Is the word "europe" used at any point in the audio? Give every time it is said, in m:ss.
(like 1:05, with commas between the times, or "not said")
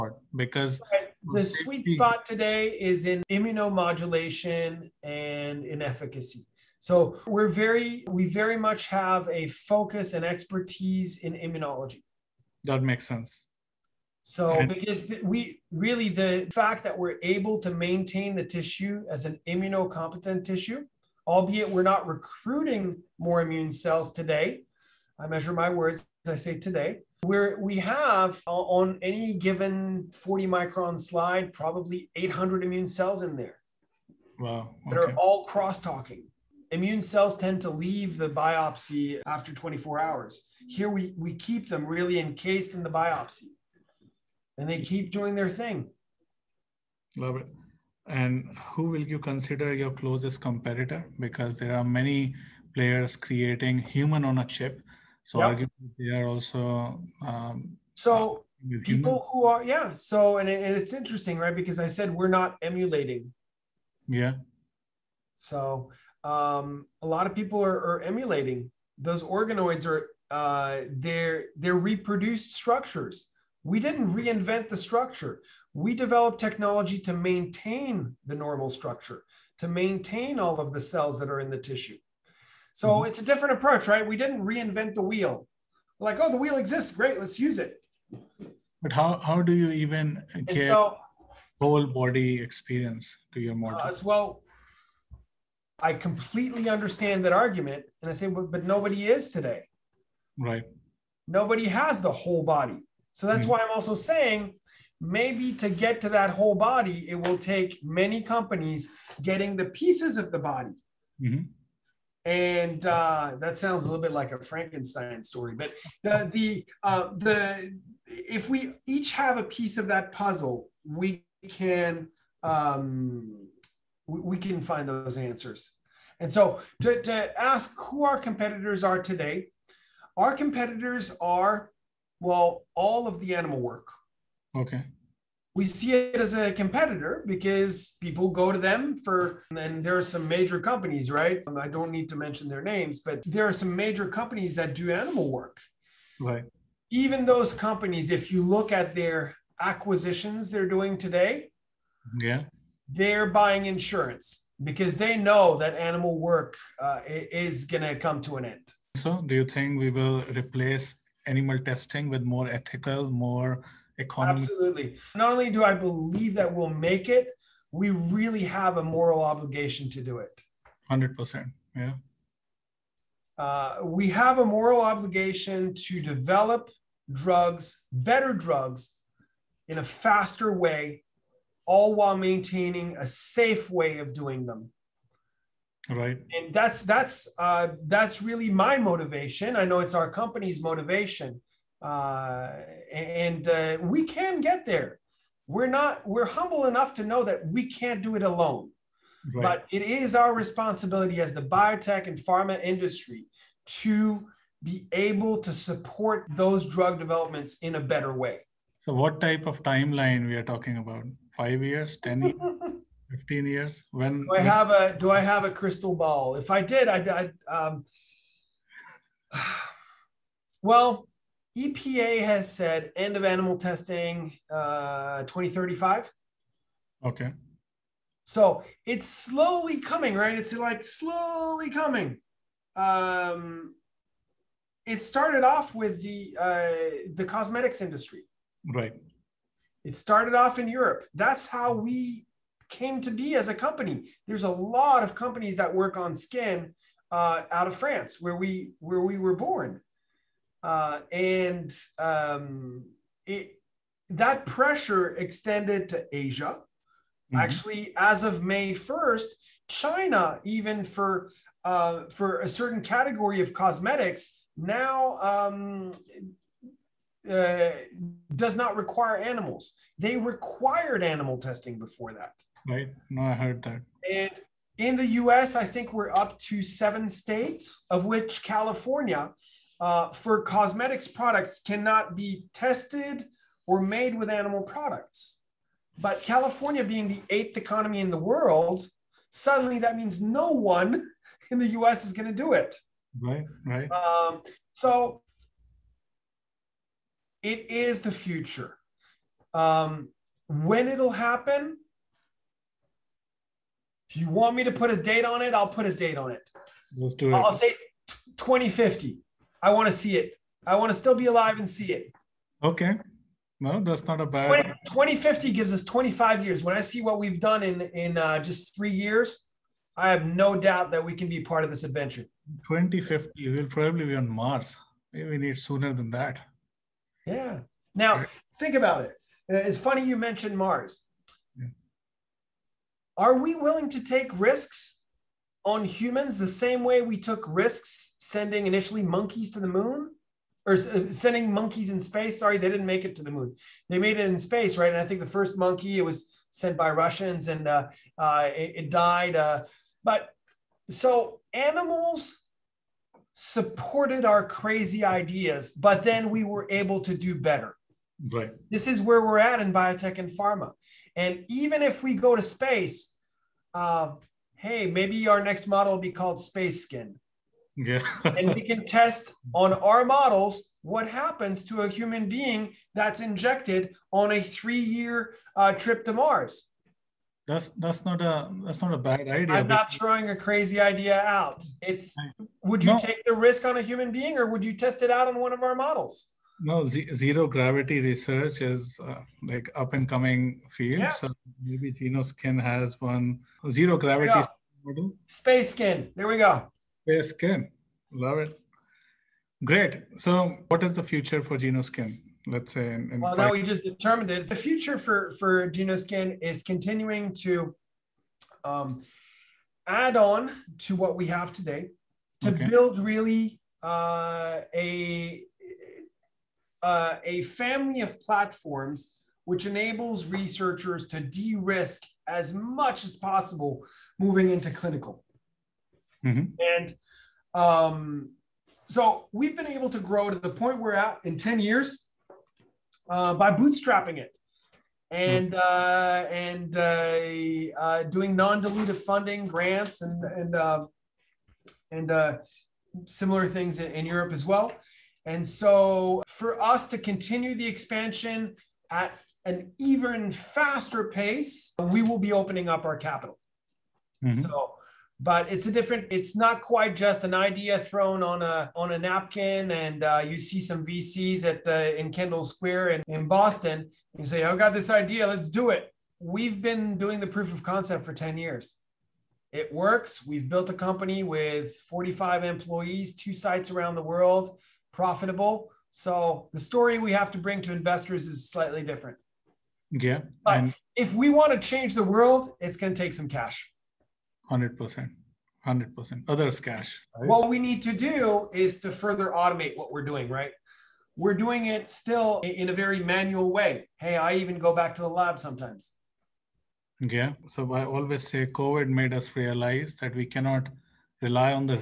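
4:00, 7:24.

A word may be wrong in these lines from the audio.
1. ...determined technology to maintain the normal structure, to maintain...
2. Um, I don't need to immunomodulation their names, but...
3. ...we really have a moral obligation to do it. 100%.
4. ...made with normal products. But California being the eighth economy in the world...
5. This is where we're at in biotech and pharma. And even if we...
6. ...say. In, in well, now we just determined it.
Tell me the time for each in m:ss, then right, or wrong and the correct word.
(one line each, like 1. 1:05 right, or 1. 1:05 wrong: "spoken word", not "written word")
1. 1:15 wrong: "developed", not "determined"
2. 2:21 wrong: "mention", not "immunomodulation"
3. 2:47 right
4. 4:43 wrong: "animal", not "normal"
5. 5:58 right
6. 6:42 right.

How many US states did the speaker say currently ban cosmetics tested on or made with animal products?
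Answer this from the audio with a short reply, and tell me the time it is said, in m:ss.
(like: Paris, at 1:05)
seven, at 4:36.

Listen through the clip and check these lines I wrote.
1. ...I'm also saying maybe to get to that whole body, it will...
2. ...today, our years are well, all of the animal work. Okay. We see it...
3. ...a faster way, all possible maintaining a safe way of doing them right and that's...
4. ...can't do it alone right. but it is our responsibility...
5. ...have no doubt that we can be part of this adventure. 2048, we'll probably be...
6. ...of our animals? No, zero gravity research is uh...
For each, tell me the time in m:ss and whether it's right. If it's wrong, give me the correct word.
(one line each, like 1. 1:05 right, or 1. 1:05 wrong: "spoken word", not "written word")
1. 1:43 right
2. 2:08 wrong: "competitors", not "years"
3. 2:59 wrong: "while", not "possible"
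4. 3:17 right
5. 5:20 wrong: "2050", not "2048"
6. 6:25 wrong: "models", not "animals".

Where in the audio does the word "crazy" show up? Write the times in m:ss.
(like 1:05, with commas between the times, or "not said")
5:54, 6:20.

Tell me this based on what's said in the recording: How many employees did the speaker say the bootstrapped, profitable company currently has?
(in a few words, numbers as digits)
45.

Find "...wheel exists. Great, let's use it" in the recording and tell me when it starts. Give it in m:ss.
1:26.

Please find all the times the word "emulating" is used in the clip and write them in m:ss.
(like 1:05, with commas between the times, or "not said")
1:02, 1:08.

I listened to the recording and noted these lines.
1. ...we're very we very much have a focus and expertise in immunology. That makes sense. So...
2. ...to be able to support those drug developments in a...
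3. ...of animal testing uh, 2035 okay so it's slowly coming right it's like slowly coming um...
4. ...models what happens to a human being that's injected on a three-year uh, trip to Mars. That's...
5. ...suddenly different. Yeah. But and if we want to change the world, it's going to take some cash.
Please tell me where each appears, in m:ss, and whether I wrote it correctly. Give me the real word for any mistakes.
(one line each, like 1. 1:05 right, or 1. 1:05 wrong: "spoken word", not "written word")
1. 0:07 right
2. 3:23 right
3. 3:43 right
4. 6:10 right
5. 7:58 wrong: "slightly", not "suddenly".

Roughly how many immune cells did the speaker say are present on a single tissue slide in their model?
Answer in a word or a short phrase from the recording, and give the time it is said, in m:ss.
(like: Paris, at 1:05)
800, at 0:32.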